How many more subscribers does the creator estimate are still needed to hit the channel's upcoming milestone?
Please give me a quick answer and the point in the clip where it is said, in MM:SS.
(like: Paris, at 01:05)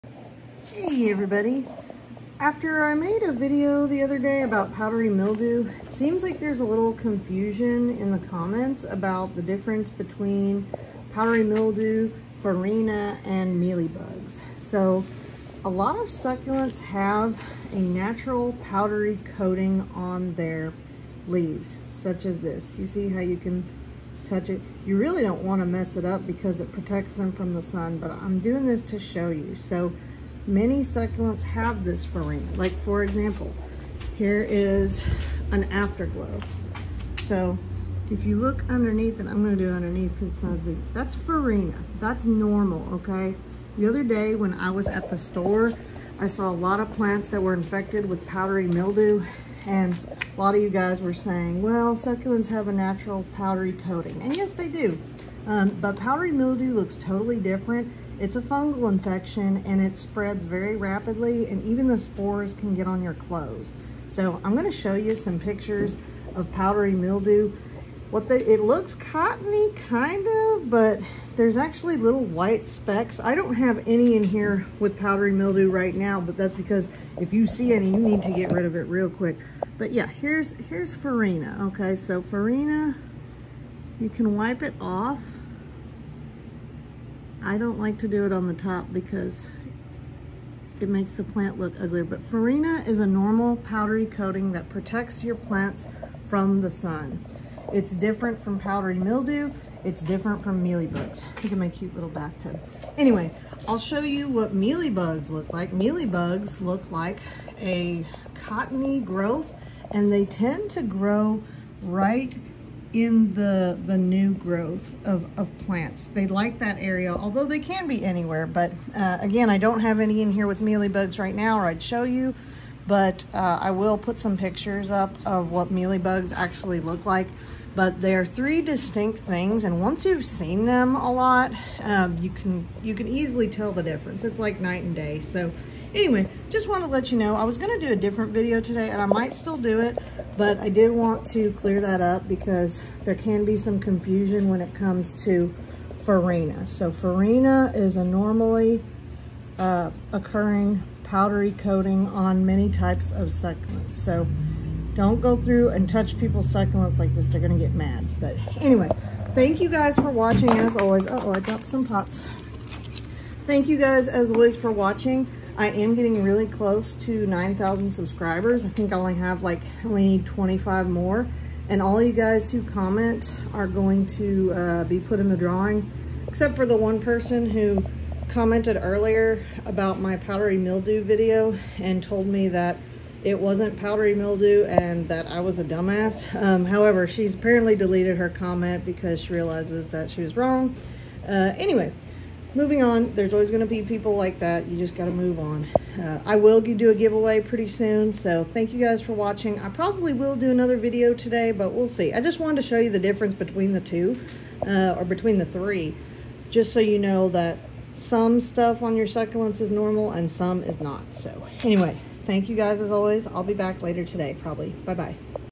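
25, at 02:50.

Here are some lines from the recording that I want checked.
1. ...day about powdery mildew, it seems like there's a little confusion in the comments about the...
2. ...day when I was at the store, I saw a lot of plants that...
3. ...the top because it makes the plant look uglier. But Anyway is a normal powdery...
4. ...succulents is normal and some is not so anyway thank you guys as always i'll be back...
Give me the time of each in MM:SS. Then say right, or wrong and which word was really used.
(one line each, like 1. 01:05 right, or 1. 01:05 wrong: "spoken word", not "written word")
1. 00:04 right
2. 00:44 right
3. 01:28 wrong: "Farina", not "Anyway"
4. 03:29 right.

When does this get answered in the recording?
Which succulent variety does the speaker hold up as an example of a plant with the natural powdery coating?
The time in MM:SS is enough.
00:35.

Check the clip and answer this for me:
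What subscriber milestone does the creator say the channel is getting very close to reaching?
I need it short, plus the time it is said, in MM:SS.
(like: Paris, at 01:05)
9,000, at 02:47.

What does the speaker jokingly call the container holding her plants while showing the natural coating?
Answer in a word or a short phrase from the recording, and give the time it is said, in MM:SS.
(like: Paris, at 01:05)
bathtub, at 01:42.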